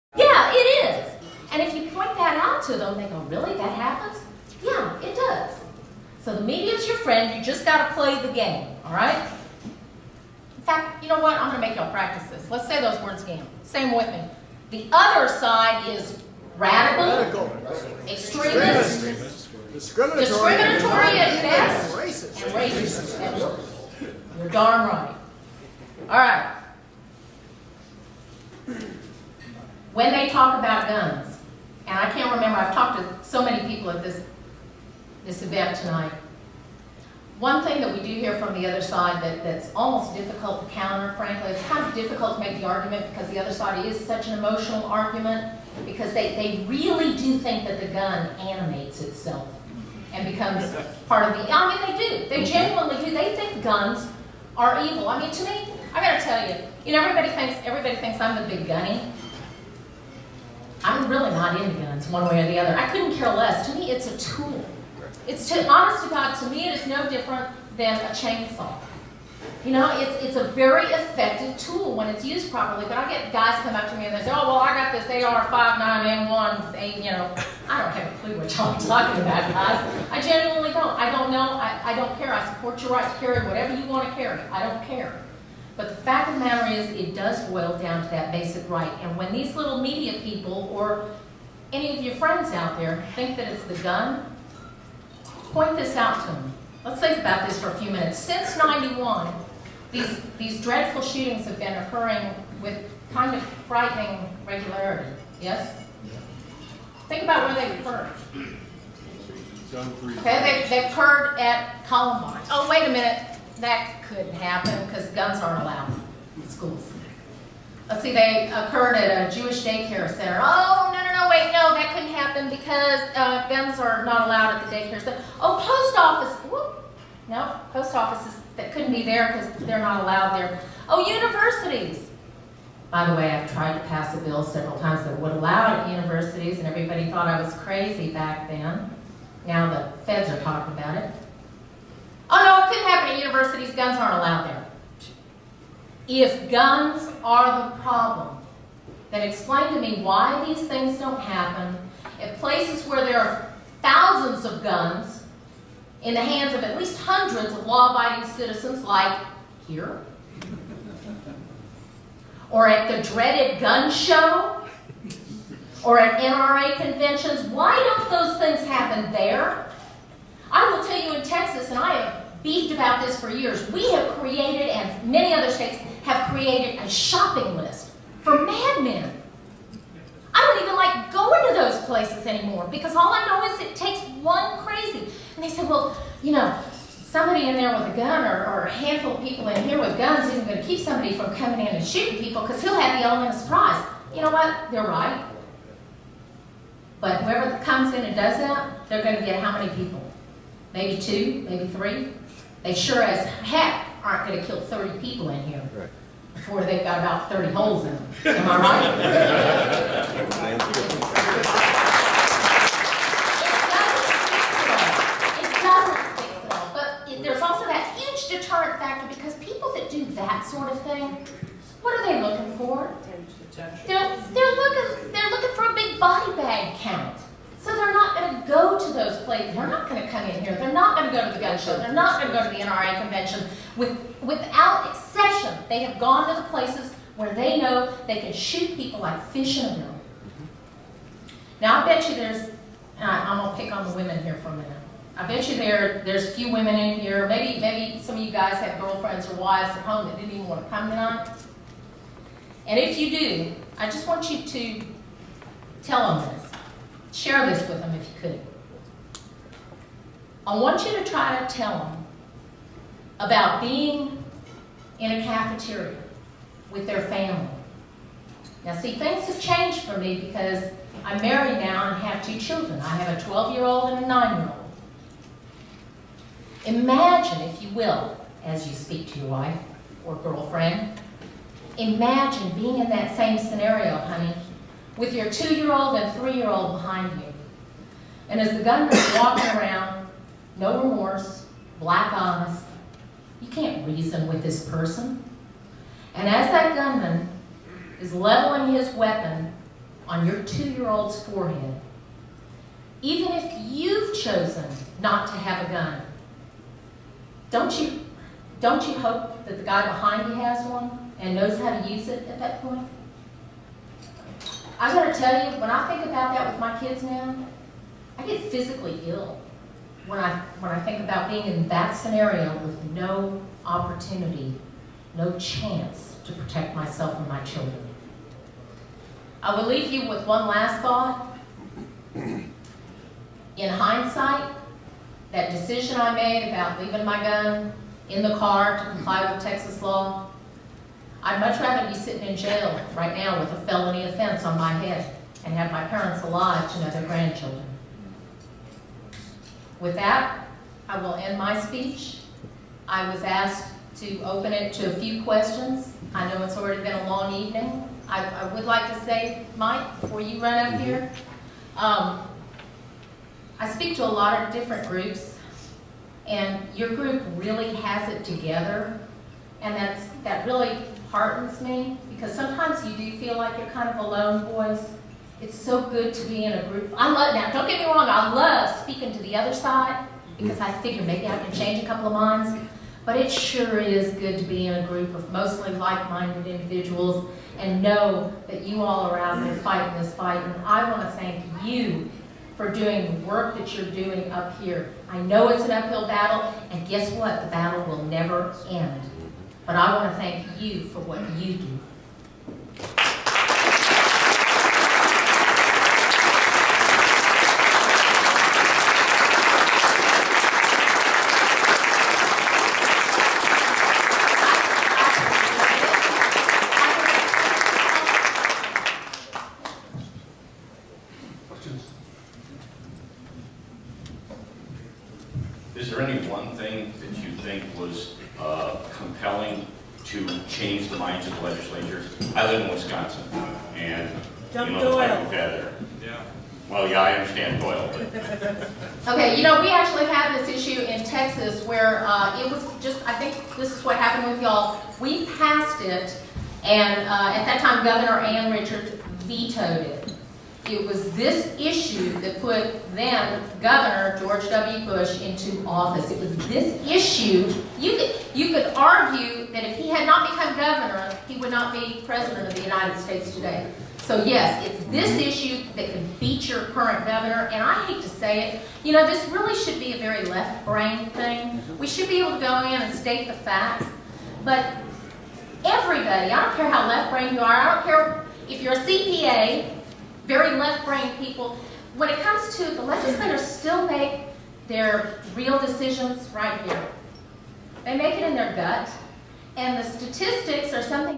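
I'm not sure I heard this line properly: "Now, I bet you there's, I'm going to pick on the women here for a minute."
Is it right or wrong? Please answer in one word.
right.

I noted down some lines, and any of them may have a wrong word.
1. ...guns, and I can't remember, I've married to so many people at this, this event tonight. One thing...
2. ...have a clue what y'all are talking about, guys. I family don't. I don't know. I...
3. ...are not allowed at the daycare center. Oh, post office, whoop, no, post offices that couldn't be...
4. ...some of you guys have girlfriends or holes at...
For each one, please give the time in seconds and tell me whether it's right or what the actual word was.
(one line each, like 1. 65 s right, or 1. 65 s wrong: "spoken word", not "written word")
1. 30 s wrong: "talked", not "married"
2. 77 s wrong: "genuinely", not "family"
3. 123 s right
4. 248 s wrong: "wives", not "holes".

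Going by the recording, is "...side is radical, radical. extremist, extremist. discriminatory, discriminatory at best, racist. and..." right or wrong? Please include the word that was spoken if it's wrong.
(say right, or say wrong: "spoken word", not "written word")
right.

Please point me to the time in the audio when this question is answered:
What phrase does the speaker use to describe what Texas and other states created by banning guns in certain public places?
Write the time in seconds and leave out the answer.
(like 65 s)
176 s.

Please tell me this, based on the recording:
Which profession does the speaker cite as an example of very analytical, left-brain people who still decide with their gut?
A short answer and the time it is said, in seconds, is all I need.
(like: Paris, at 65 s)
CPA, at 478 s.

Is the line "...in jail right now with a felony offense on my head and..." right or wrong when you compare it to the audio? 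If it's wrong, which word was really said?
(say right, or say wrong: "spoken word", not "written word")
right.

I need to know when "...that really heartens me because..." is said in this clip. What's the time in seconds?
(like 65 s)
370 s.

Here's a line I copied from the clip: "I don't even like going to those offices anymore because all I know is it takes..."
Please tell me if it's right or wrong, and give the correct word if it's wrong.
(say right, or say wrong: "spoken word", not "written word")
wrong: "places", not "offices".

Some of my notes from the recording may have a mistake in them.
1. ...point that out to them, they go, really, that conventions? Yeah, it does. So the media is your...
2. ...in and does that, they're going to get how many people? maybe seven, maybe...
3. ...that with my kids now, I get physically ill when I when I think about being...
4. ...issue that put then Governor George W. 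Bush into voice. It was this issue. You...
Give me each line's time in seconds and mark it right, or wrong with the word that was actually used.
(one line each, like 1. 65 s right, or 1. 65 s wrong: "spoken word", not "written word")
1. 1 s wrong: "happens", not "conventions"
2. 197 s wrong: "two", not "seven"
3. 316 s right
4. 451 s wrong: "office", not "voice".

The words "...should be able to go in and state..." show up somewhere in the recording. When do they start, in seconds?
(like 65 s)
471 s.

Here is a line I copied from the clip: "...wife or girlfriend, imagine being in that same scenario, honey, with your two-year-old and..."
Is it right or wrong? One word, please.
right.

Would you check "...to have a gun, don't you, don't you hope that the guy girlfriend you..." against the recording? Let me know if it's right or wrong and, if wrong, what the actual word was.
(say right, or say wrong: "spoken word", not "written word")
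wrong: "behind", not "girlfriend".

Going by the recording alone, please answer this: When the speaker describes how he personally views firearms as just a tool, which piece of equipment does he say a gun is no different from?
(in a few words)
chainsaw.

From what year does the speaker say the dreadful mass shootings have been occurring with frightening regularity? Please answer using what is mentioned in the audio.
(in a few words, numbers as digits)
1991.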